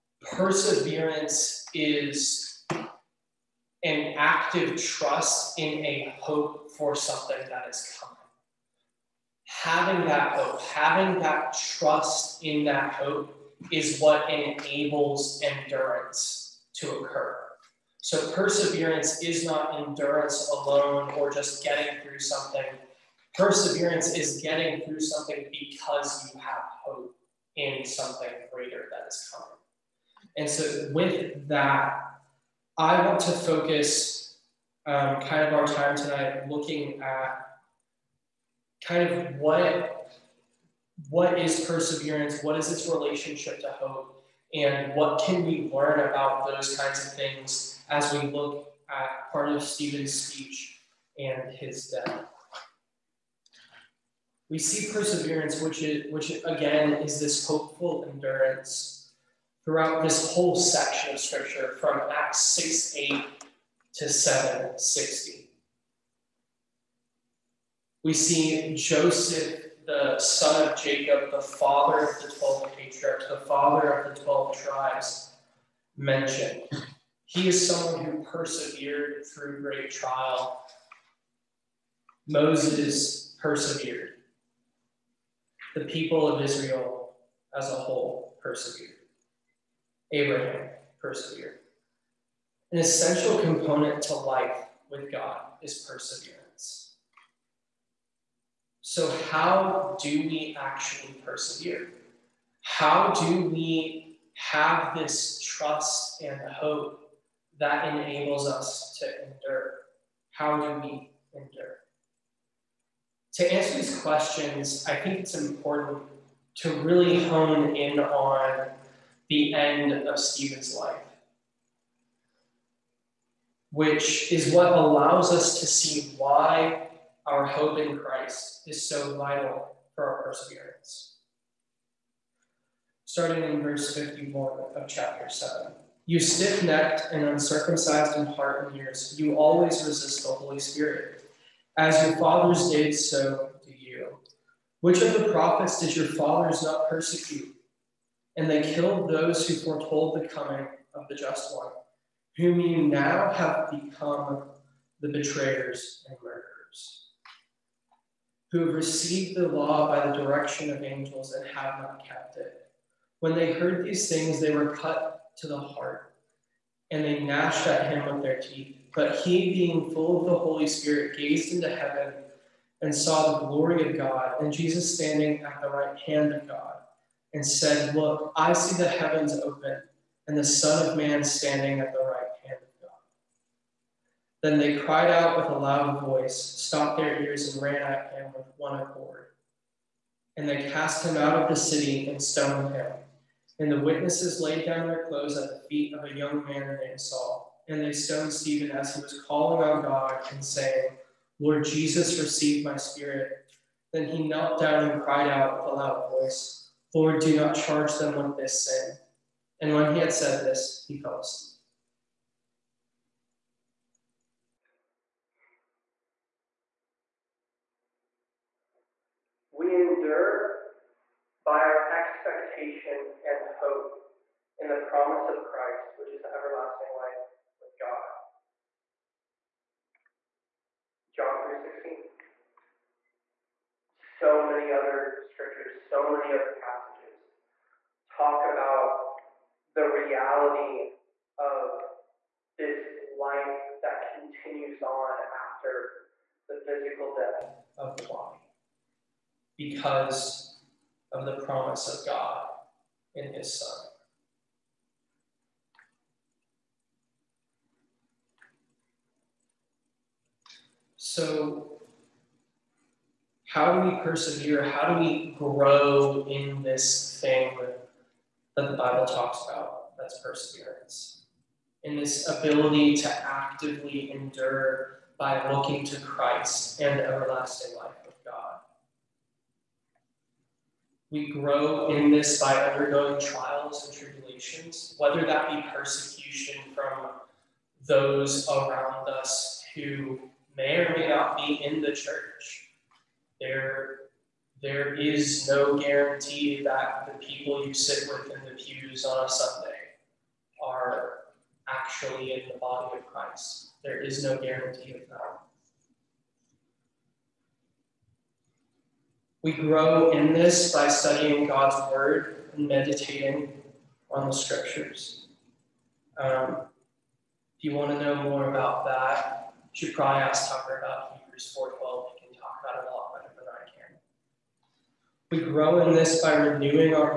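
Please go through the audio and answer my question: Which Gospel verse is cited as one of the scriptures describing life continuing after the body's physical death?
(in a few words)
John 3:16.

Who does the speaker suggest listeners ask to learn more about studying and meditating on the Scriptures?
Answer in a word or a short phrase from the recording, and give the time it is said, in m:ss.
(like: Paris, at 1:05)
Tucker, at 5:20.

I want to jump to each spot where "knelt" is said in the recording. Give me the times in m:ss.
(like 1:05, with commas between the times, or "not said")
3:24.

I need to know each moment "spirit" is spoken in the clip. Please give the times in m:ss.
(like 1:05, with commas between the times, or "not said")
2:20, 2:50, 3:22.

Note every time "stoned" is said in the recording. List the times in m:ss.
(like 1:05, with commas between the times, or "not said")
3:12, 3:17.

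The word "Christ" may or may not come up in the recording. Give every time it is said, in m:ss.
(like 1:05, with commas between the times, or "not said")
2:07, 3:45, 4:36, 5:03.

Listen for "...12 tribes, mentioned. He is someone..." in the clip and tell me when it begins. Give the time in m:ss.
1:14.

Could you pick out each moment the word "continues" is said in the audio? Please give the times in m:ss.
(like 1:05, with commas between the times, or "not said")
4:04.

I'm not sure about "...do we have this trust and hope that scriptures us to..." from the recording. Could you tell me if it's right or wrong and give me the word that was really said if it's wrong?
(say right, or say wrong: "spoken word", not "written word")
wrong: "enables", not "scriptures".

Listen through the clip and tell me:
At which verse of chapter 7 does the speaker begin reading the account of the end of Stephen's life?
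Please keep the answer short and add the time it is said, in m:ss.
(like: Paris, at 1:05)
51, at 2:13.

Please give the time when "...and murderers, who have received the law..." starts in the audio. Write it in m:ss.
2:36.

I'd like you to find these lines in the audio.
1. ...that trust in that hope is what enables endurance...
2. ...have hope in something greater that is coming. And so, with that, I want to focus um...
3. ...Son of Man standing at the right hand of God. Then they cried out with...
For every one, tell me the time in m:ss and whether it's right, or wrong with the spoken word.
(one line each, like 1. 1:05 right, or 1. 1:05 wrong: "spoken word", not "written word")
1. 0:11 right
2. 0:26 right
3. 3:00 right.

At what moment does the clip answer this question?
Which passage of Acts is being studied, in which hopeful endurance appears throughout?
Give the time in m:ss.
1:02.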